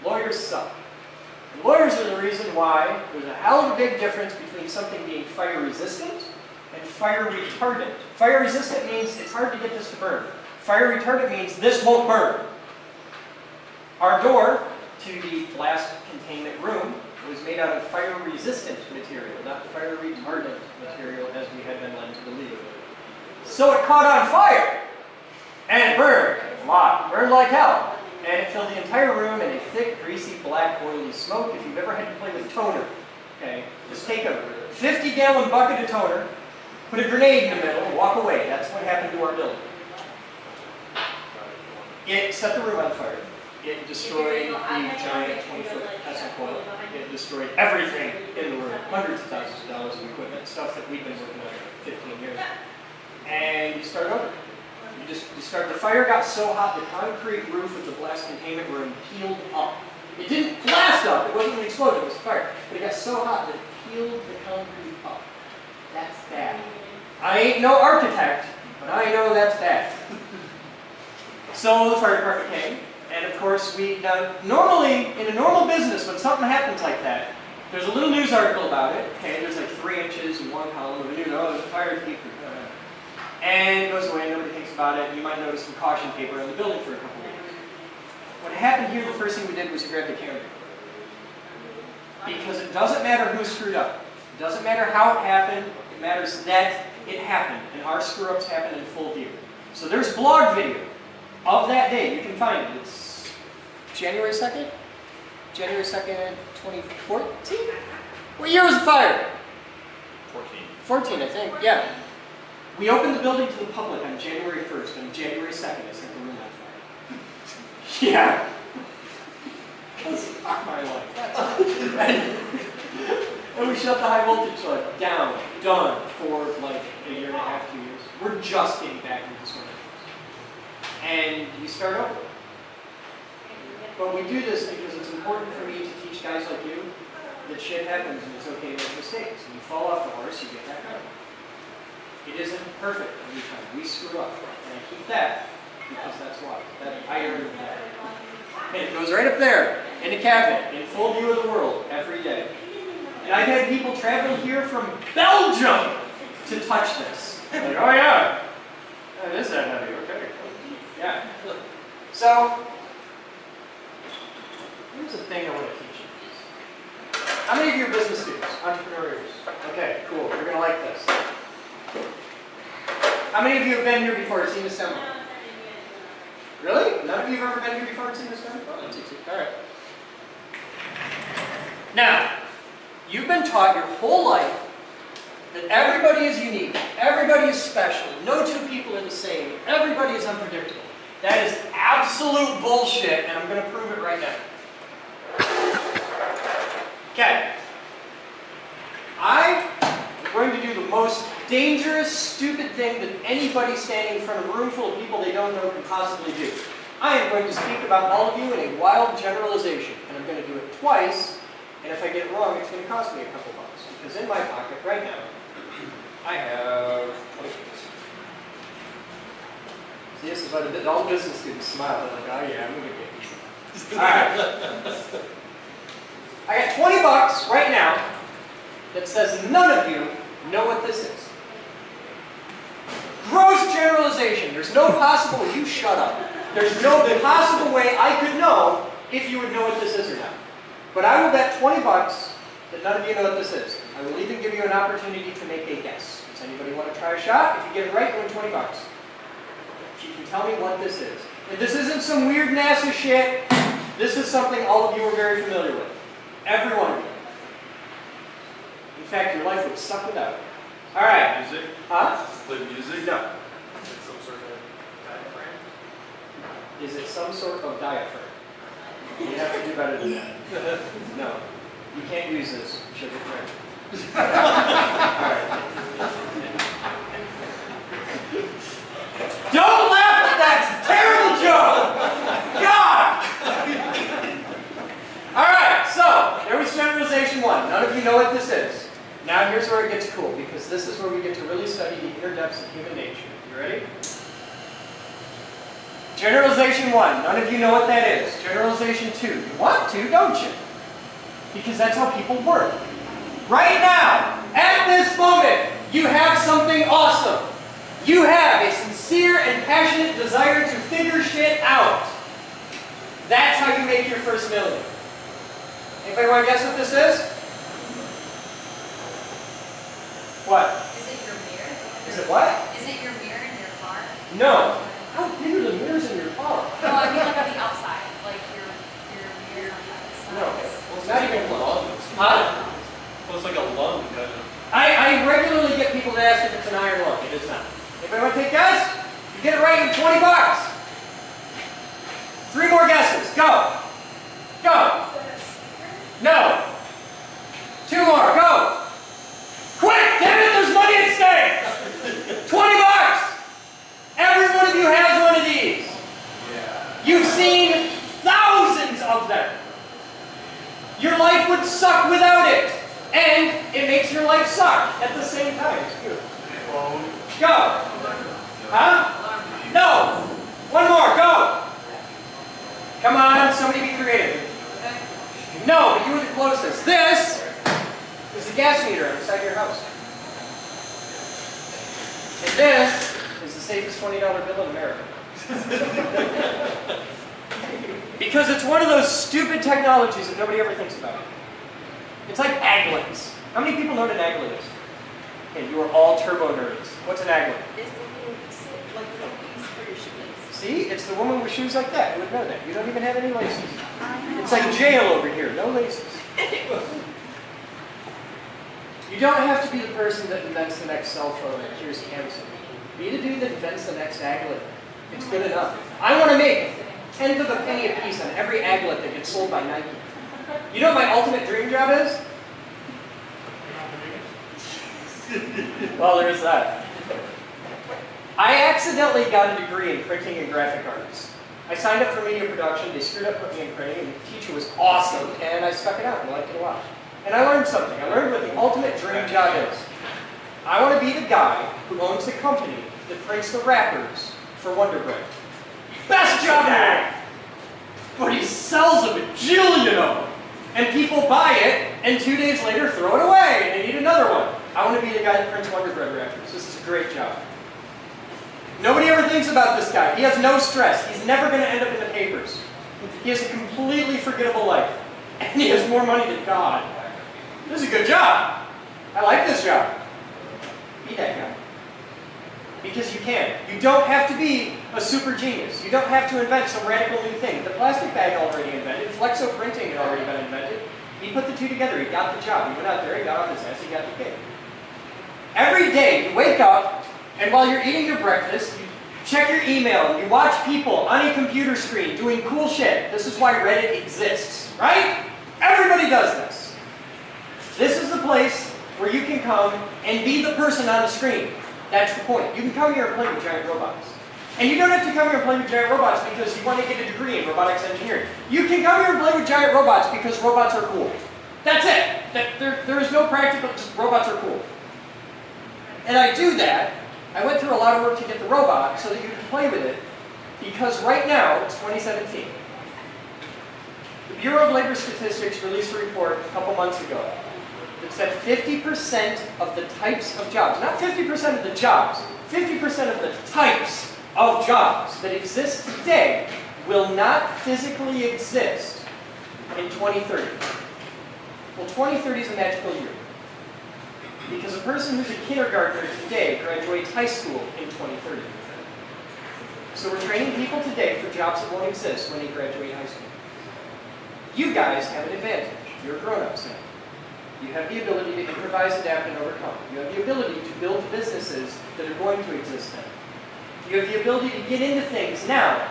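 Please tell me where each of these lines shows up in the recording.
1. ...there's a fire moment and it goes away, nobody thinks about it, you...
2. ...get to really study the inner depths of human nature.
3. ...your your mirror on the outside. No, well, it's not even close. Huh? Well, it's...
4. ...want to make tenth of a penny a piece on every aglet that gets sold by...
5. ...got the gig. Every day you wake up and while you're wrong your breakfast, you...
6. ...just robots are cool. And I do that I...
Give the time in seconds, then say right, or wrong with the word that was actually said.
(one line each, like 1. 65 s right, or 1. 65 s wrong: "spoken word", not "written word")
1. 81 s wrong: "department", not "moment"
2. 291 s right
3. 328 s right
4. 416 s right
5. 483 s wrong: "eating", not "wrong"
6. 513 s right.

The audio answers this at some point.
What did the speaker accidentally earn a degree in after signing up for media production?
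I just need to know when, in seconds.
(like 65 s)
430 s.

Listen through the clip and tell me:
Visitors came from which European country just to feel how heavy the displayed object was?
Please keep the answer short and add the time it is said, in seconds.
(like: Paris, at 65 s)
Belgium, at 155 s.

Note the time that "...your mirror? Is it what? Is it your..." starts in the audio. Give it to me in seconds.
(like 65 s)
321 s.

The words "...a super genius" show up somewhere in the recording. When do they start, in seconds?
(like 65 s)
474 s.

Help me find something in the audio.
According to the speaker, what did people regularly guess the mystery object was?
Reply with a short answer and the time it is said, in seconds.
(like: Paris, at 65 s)
an iron lung, at 336 s.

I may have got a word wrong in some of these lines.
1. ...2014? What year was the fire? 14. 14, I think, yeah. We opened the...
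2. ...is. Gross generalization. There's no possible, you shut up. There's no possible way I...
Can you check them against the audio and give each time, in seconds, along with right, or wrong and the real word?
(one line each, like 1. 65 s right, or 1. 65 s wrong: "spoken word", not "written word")
1. 106 s right
2. 231 s right.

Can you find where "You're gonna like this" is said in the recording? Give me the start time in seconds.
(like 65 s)
170 s.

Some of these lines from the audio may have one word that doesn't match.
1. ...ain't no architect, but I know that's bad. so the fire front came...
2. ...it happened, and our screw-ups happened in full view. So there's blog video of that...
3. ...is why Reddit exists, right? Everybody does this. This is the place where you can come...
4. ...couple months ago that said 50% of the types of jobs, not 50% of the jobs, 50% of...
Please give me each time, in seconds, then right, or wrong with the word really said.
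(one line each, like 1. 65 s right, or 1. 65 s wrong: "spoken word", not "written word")
1. 67 s wrong: "department", not "front"
2. 97 s right
3. 493 s right
4. 526 s right.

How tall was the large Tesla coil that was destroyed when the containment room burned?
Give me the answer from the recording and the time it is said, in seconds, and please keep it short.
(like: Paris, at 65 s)
20 feet, at 45 s.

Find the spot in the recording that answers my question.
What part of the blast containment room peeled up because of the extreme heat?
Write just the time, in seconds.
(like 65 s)
56 s.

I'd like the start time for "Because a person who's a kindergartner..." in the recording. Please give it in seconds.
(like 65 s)
544 s.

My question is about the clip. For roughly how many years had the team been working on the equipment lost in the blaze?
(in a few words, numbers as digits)
15 years.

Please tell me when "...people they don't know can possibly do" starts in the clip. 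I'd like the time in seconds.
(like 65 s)
204 s.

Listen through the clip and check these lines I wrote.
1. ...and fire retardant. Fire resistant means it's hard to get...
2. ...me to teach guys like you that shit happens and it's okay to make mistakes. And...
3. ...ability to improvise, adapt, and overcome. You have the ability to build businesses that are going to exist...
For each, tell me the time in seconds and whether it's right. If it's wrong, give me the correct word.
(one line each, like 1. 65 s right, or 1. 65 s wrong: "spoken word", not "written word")
1. 6 s right
2. 135 s right
3. 558 s right.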